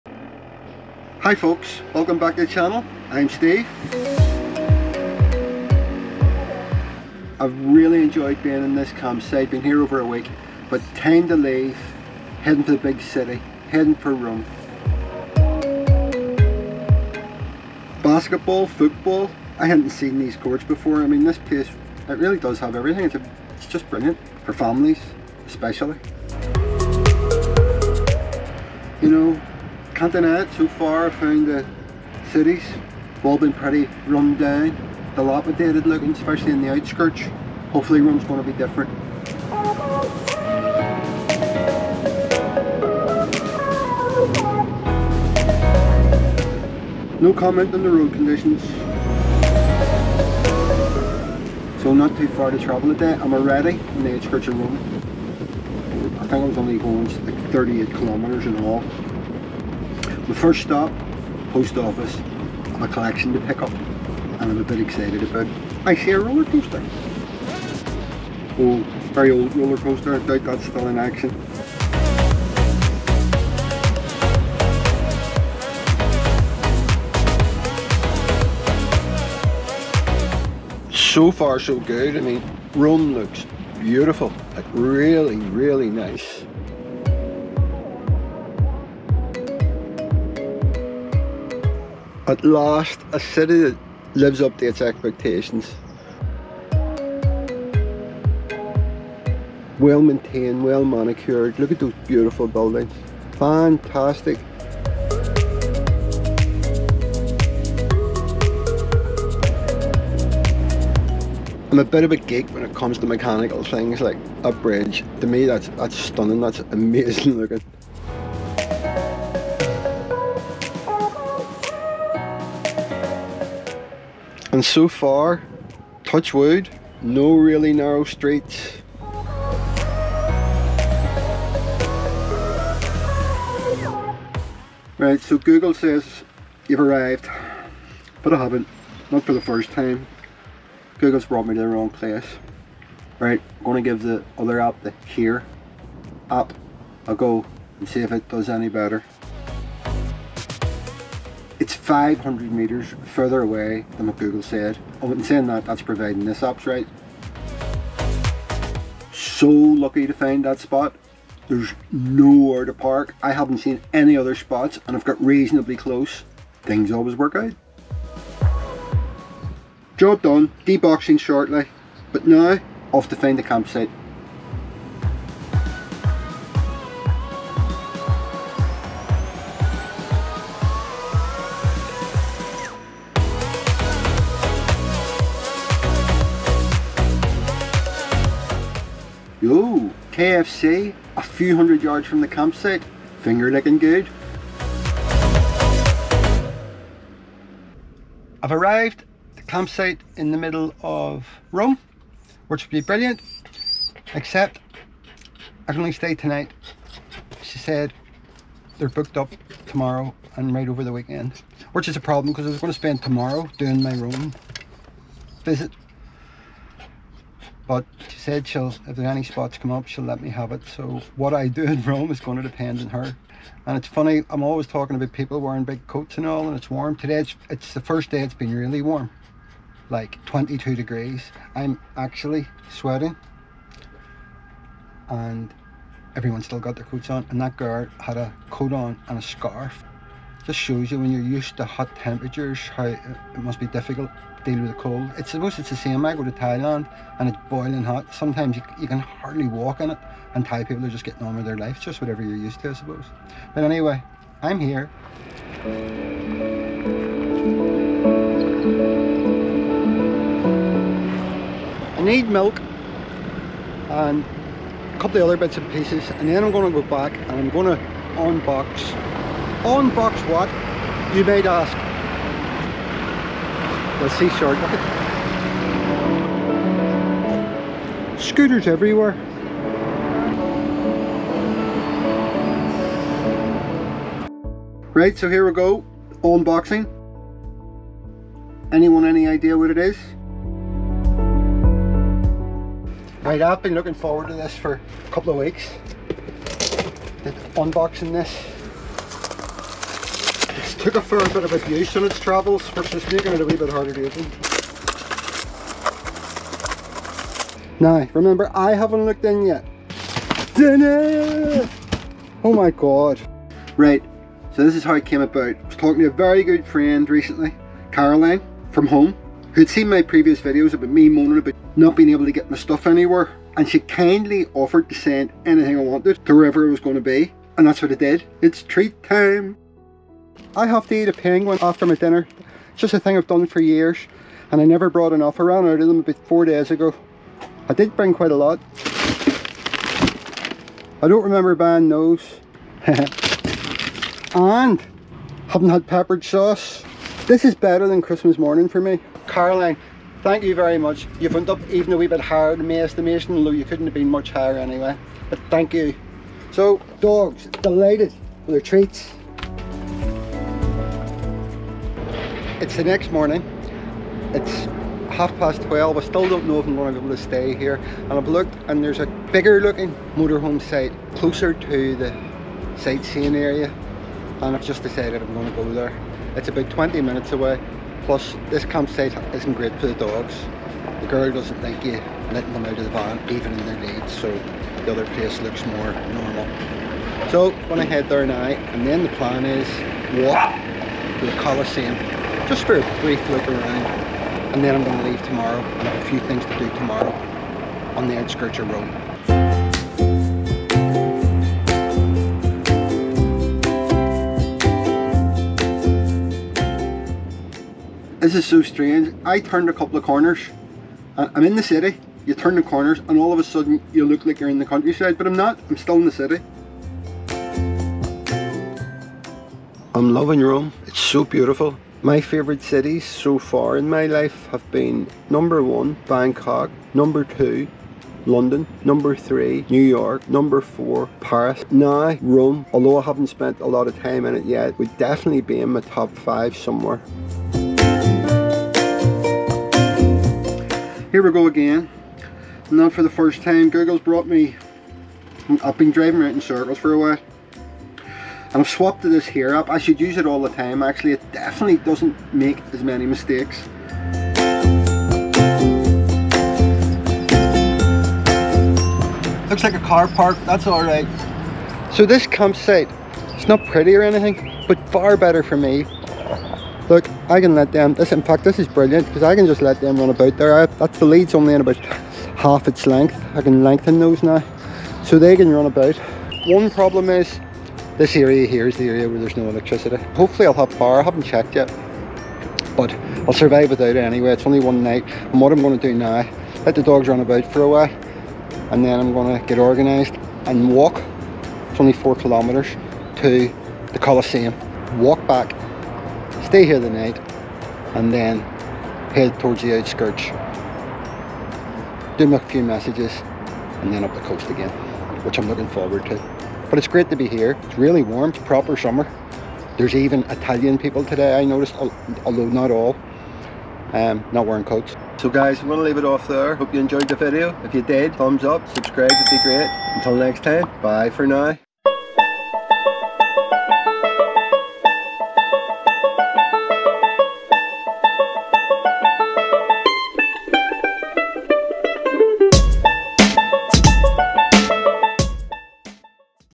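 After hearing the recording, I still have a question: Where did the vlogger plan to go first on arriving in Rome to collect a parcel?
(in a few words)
post office.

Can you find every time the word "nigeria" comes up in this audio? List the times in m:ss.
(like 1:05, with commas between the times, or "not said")
not said.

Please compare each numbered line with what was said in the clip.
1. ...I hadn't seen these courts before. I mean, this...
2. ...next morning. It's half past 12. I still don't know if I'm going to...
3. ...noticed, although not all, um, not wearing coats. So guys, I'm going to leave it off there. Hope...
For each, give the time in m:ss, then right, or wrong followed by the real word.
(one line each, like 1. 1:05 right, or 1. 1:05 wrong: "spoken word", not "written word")
1. 0:19 right
2. 6:02 right
3. 8:31 right.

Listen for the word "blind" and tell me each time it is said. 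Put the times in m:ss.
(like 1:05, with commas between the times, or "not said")
not said.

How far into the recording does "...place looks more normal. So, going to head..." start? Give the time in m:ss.
6:25.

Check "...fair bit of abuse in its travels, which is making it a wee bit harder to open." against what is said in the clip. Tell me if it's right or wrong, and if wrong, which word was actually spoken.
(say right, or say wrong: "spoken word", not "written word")
right.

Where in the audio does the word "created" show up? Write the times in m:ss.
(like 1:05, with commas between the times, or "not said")
not said.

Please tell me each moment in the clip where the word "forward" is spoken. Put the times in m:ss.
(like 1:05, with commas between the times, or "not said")
4:53, 8:25.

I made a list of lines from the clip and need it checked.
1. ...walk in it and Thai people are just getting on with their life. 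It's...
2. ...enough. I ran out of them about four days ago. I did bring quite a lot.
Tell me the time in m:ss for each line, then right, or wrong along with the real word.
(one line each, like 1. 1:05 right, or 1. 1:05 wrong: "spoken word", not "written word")
1. 4:09 right
2. 5:35 right.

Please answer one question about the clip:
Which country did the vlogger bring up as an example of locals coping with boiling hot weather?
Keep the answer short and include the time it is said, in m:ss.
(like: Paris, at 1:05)
Thailand, at 4:06.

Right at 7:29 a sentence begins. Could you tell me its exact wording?
I should use it all the time actually.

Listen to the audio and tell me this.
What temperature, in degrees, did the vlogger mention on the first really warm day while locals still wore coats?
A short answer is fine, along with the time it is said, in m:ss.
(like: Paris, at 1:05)
22, at 3:50.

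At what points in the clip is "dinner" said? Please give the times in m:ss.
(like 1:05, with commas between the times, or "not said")
5:10, 5:31.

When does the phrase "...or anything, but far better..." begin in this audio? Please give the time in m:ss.
7:43.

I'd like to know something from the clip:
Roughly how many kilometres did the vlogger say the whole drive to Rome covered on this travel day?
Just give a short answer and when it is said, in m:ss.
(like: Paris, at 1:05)
38, at 0:57.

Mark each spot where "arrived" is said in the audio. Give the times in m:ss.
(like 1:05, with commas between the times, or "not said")
2:16, 3:18.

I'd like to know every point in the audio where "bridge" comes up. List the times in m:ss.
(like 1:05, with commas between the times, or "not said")
1:54.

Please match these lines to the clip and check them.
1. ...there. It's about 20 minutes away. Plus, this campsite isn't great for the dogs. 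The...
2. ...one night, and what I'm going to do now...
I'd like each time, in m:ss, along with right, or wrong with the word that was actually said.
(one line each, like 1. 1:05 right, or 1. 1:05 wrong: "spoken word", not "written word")
1. 6:15 right
2. 8:04 right.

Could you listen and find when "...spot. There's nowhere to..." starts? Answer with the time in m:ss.
2:40.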